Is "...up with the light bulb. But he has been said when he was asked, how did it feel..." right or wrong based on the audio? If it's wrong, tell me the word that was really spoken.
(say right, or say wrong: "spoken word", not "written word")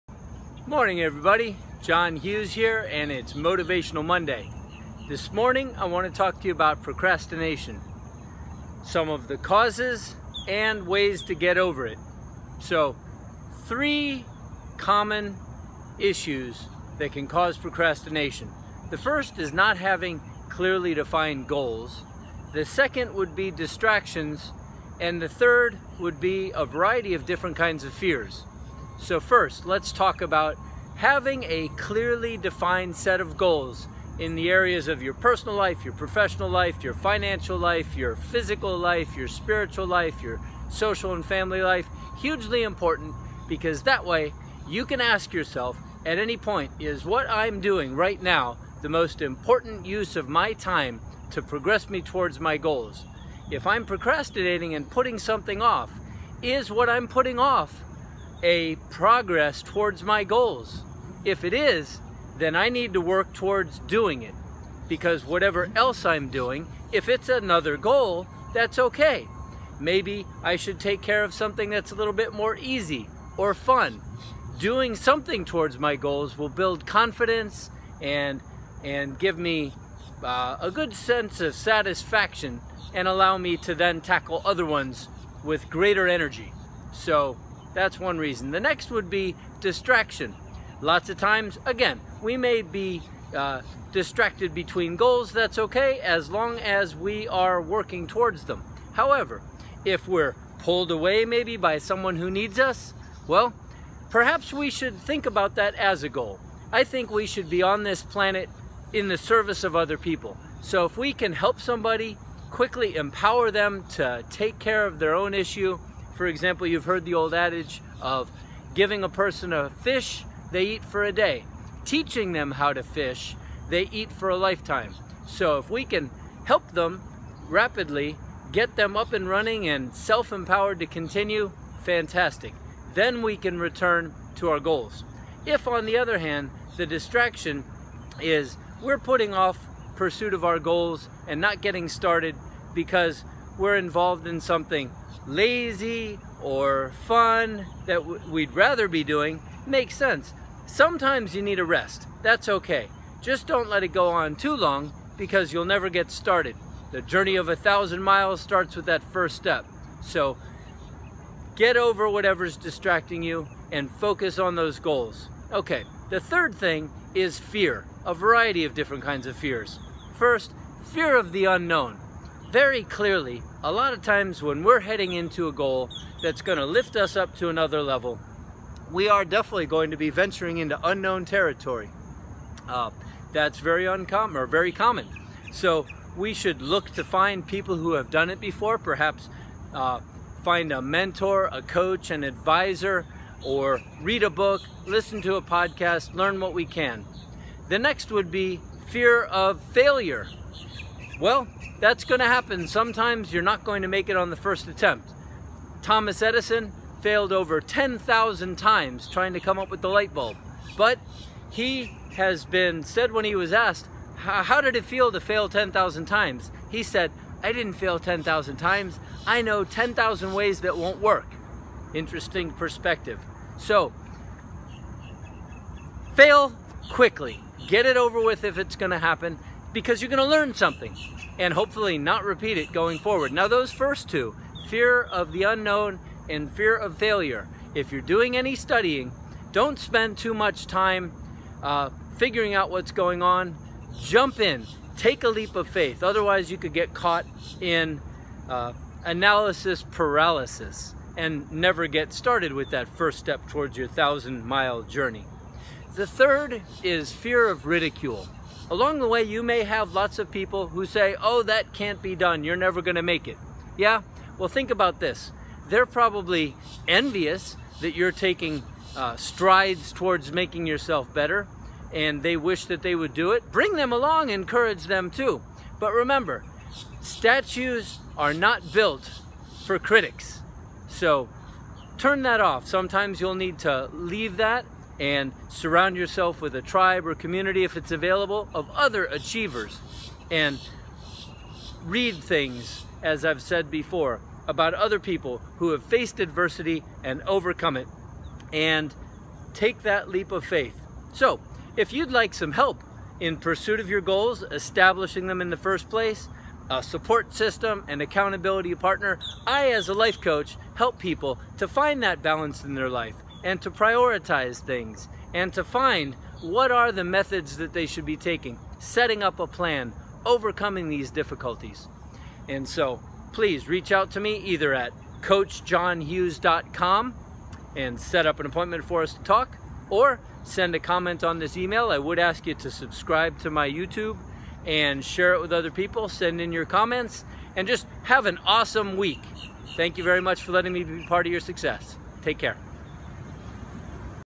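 right.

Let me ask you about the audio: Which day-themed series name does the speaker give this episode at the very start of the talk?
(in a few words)
Motivational Monday.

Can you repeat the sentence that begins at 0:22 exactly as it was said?
The second would be distractions and the third would be a variety of different kinds of fears.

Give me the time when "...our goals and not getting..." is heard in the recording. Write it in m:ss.
2:20.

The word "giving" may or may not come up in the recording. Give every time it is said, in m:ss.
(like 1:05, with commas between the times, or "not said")
1:58.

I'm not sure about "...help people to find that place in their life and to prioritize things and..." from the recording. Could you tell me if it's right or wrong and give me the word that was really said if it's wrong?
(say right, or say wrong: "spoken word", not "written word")
wrong: "balance", not "place".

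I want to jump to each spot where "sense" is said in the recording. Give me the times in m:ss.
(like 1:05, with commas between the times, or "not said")
1:20, 2:29.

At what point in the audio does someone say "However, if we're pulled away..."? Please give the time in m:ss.
1:38.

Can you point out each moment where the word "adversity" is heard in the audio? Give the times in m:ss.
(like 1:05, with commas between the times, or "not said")
4:56.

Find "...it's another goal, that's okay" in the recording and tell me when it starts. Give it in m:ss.
1:07.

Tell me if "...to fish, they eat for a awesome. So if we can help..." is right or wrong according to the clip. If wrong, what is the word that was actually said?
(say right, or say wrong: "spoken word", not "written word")
wrong: "lifetime", not "awesome".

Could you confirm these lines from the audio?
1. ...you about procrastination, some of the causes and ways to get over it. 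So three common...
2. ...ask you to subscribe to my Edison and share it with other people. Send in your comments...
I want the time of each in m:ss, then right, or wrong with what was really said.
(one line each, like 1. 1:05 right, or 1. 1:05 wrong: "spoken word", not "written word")
1. 0:06 right
2. 5:32 wrong: "YouTube", not "Edison".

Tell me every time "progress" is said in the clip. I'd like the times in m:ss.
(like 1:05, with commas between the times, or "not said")
0:51, 0:58.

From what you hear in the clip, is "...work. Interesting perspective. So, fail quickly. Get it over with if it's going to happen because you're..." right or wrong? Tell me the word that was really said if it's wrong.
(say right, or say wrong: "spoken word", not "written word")
right.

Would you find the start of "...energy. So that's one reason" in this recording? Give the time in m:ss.
1:26.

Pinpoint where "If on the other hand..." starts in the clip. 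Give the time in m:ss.
2:15.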